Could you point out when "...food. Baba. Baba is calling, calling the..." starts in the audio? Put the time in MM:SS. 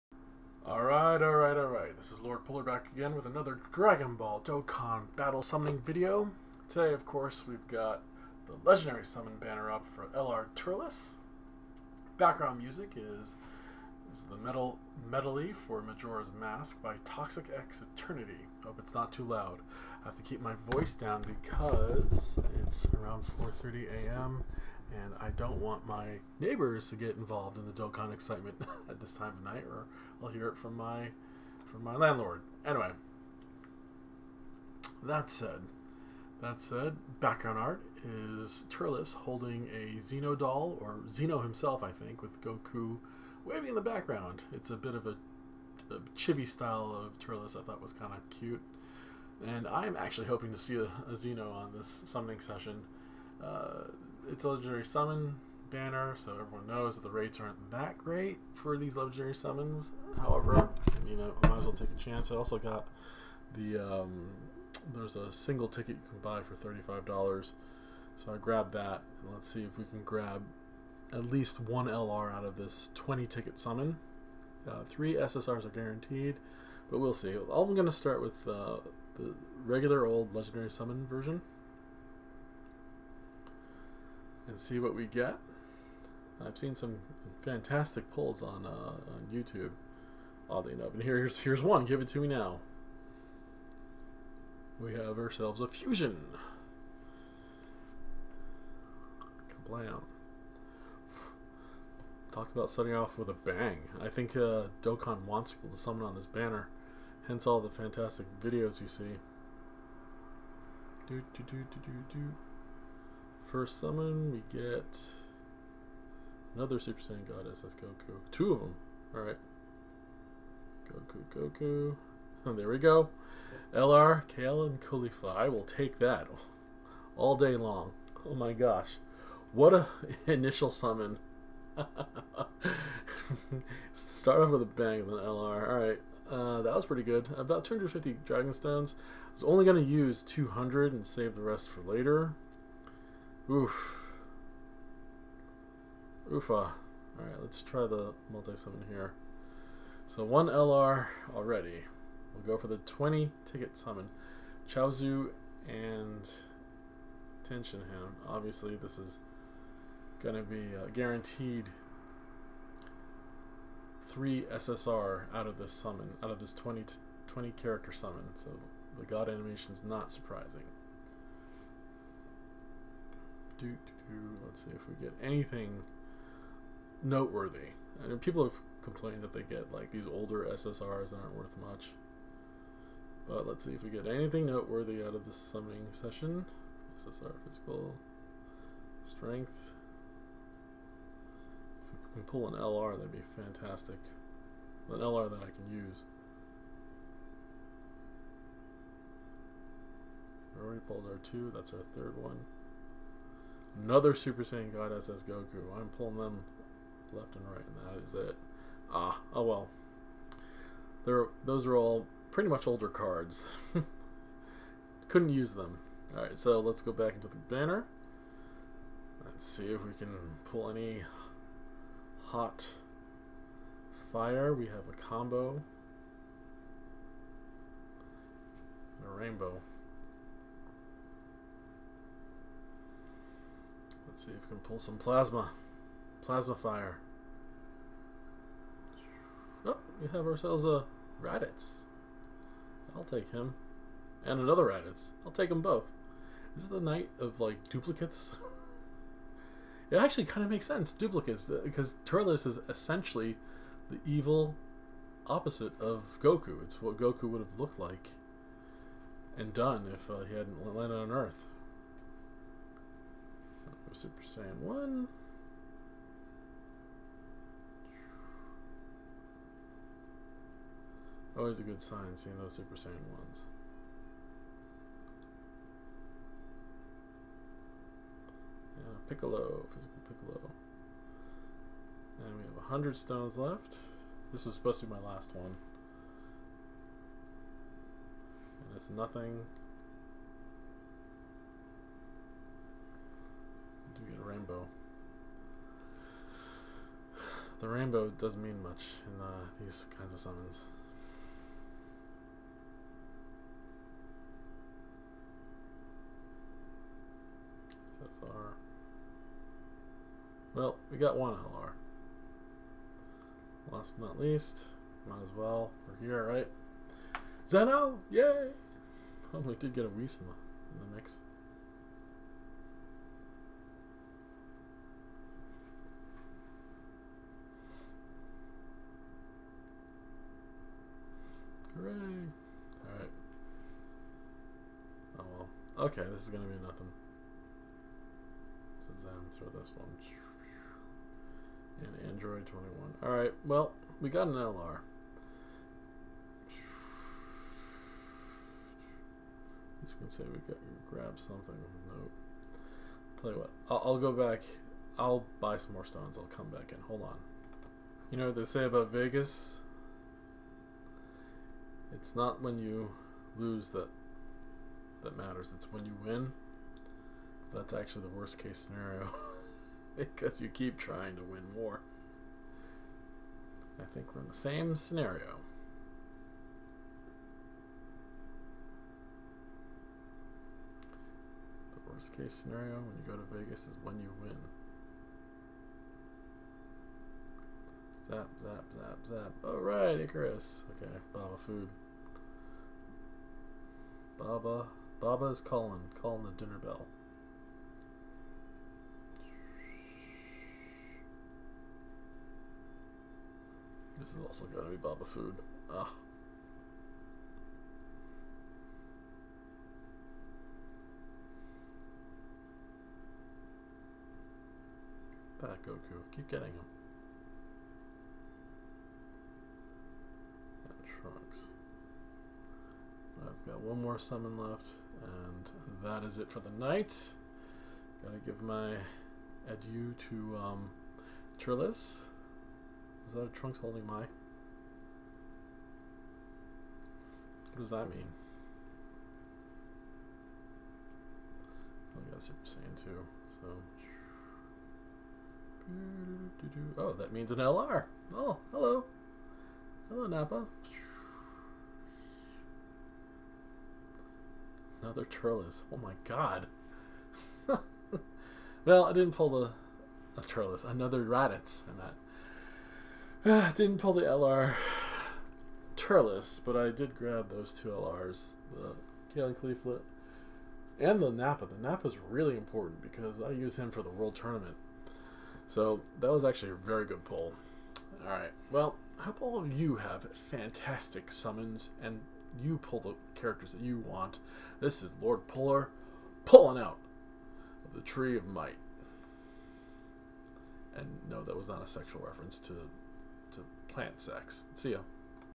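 06:31.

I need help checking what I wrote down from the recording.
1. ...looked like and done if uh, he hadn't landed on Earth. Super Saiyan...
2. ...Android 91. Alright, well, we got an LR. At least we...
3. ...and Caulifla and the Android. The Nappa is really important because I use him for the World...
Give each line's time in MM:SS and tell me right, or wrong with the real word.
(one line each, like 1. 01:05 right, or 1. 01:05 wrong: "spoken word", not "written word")
1. 04:17 right
2. 05:42 wrong: "21", not "91"
3. 07:49 wrong: "Nappa", not "Android".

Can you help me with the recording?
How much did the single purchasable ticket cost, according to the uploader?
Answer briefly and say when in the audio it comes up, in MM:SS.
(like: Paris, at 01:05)
$35, at 01:06.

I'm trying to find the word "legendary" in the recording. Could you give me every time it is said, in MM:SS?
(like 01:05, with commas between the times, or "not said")
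00:08, 00:54, 00:58, 01:20.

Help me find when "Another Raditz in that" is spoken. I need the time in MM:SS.
07:40.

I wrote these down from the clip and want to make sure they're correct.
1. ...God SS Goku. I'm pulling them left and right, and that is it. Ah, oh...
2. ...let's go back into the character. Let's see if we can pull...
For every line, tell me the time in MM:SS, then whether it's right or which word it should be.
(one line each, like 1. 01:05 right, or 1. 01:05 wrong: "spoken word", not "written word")
1. 03:24 right
2. 03:36 wrong: "banner", not "character".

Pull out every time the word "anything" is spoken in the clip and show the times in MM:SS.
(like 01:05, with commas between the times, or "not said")
02:55, 03:04.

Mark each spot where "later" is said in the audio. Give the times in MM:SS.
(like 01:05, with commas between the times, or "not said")
02:21.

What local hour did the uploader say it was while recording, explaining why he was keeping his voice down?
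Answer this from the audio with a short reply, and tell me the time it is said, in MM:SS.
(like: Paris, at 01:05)
4:30 a.m., at 00:23.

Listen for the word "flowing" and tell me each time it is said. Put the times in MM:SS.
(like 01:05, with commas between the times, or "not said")
not said.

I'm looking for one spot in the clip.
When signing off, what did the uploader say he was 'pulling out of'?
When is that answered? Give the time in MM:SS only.
08:07.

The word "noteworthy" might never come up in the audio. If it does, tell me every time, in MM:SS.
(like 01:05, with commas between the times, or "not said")
02:57, 03:04.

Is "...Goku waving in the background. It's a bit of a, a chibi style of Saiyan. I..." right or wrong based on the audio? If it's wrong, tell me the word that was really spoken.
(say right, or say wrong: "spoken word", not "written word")
wrong: "Turles", not "Saiyan".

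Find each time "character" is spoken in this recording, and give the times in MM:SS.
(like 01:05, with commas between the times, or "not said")
02:47, 08:03.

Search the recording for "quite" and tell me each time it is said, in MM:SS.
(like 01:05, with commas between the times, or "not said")
not said.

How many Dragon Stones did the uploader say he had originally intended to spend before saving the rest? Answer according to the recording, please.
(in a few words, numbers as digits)
200.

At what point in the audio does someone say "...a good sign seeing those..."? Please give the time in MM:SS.
04:31.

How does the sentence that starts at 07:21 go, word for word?
I oh, got Super Saiyan 2, so...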